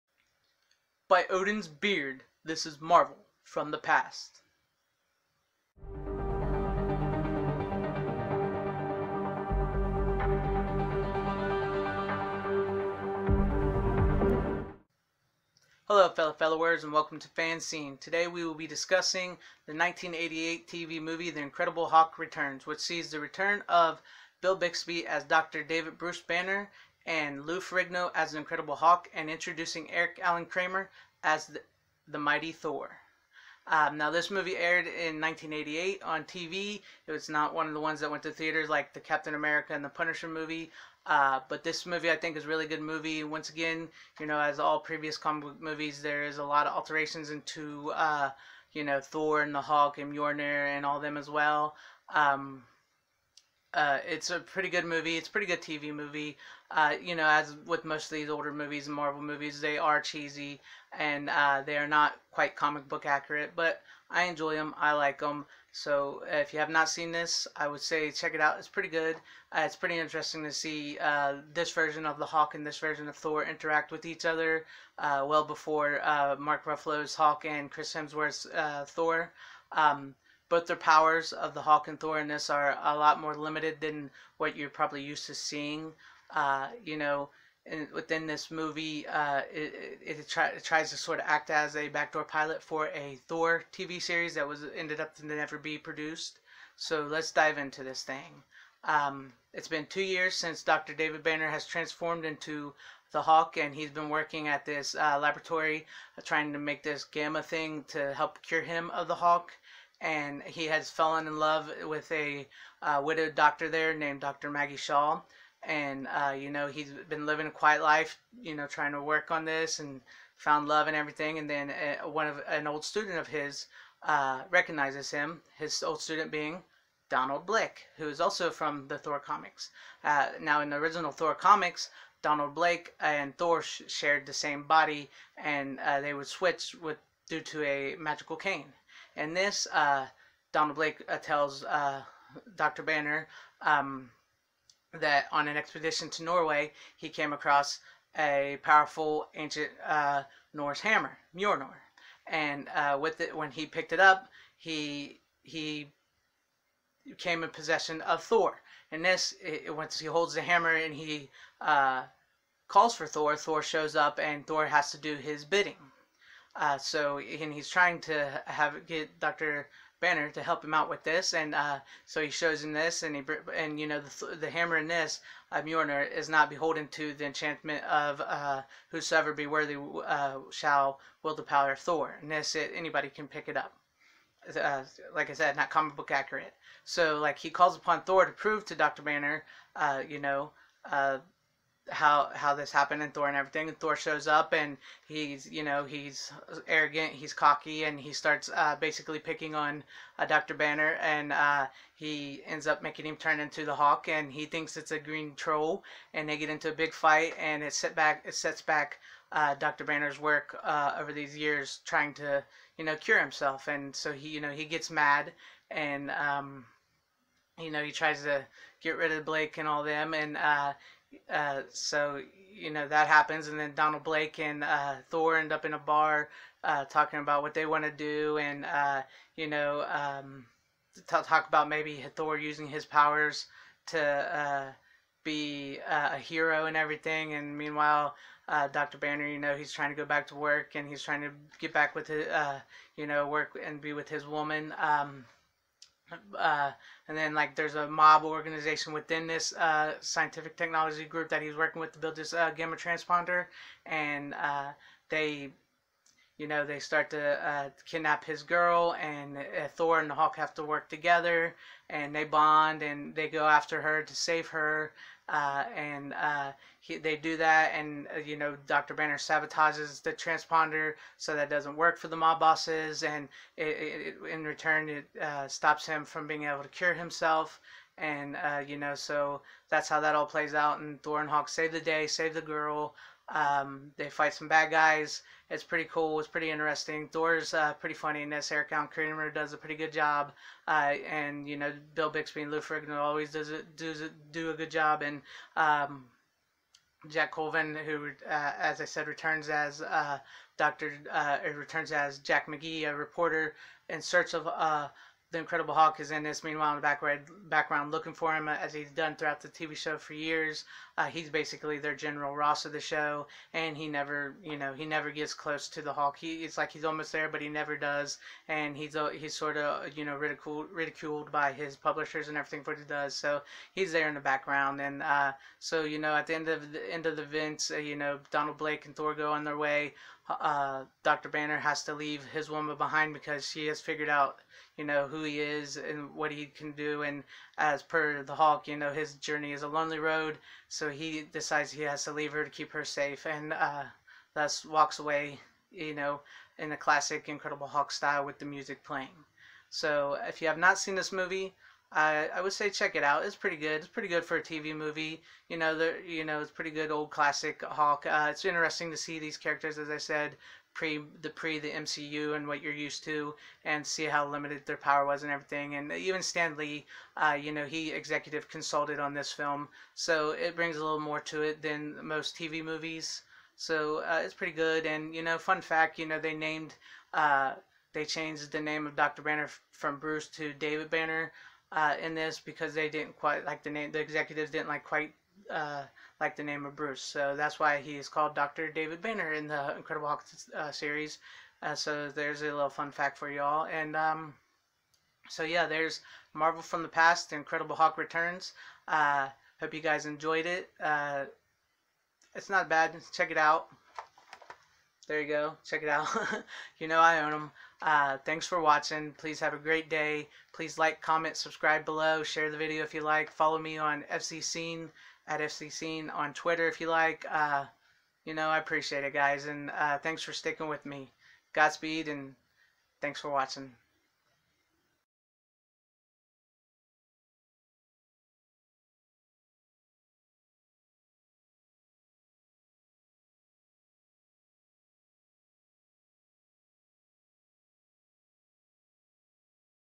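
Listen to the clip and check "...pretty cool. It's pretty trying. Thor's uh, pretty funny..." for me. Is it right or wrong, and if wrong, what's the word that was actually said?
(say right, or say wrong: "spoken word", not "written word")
wrong: "interesting", not "trying".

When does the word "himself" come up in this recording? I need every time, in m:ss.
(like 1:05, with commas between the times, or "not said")
3:33, 4:36.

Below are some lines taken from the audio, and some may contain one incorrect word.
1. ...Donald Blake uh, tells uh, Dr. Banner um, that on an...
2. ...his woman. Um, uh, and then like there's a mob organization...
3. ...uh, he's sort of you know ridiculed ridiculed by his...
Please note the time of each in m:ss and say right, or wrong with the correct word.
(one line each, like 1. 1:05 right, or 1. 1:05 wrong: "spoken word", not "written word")
1. 2:20 right
2. 4:04 right
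3. 5:18 right.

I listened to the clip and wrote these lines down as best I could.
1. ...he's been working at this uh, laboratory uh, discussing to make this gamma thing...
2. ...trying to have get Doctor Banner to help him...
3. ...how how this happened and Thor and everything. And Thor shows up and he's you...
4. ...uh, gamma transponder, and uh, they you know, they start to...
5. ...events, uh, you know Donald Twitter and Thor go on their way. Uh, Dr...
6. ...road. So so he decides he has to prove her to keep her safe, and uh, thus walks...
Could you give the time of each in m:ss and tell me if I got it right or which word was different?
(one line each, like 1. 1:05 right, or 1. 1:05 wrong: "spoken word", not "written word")
1. 1:43 wrong: "trying", not "discussing"
2. 2:47 right
3. 3:11 right
4. 4:12 right
5. 5:27 wrong: "Blake", not "Twitter"
6. 5:39 wrong: "leave", not "prove".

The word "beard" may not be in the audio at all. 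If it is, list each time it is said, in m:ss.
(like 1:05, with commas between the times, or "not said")
0:01.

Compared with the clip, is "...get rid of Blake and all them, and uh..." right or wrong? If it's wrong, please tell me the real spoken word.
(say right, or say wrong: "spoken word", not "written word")
right.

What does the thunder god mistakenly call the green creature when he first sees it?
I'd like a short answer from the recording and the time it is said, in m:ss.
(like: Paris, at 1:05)
a green troll, at 3:24.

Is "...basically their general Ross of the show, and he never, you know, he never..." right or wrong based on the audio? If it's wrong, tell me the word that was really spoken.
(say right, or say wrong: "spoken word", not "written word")
right.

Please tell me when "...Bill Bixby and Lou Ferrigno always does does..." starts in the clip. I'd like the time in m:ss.
4:51.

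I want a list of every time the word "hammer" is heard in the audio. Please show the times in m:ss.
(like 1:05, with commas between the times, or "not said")
2:30, 2:40, 2:54.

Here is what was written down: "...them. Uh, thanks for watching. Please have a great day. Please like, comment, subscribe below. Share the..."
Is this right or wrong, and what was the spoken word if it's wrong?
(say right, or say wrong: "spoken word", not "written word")
right.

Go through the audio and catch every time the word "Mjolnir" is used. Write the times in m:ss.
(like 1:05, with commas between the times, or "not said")
0:50, 2:31, 2:55.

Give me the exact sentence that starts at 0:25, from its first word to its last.
David Bruce Banner and Lou Ferrigno as an Incredible Hulk, and introducing Eric Allan Kramer as the, the Mighty Thor.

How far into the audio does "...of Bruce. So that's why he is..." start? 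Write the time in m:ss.
6:26.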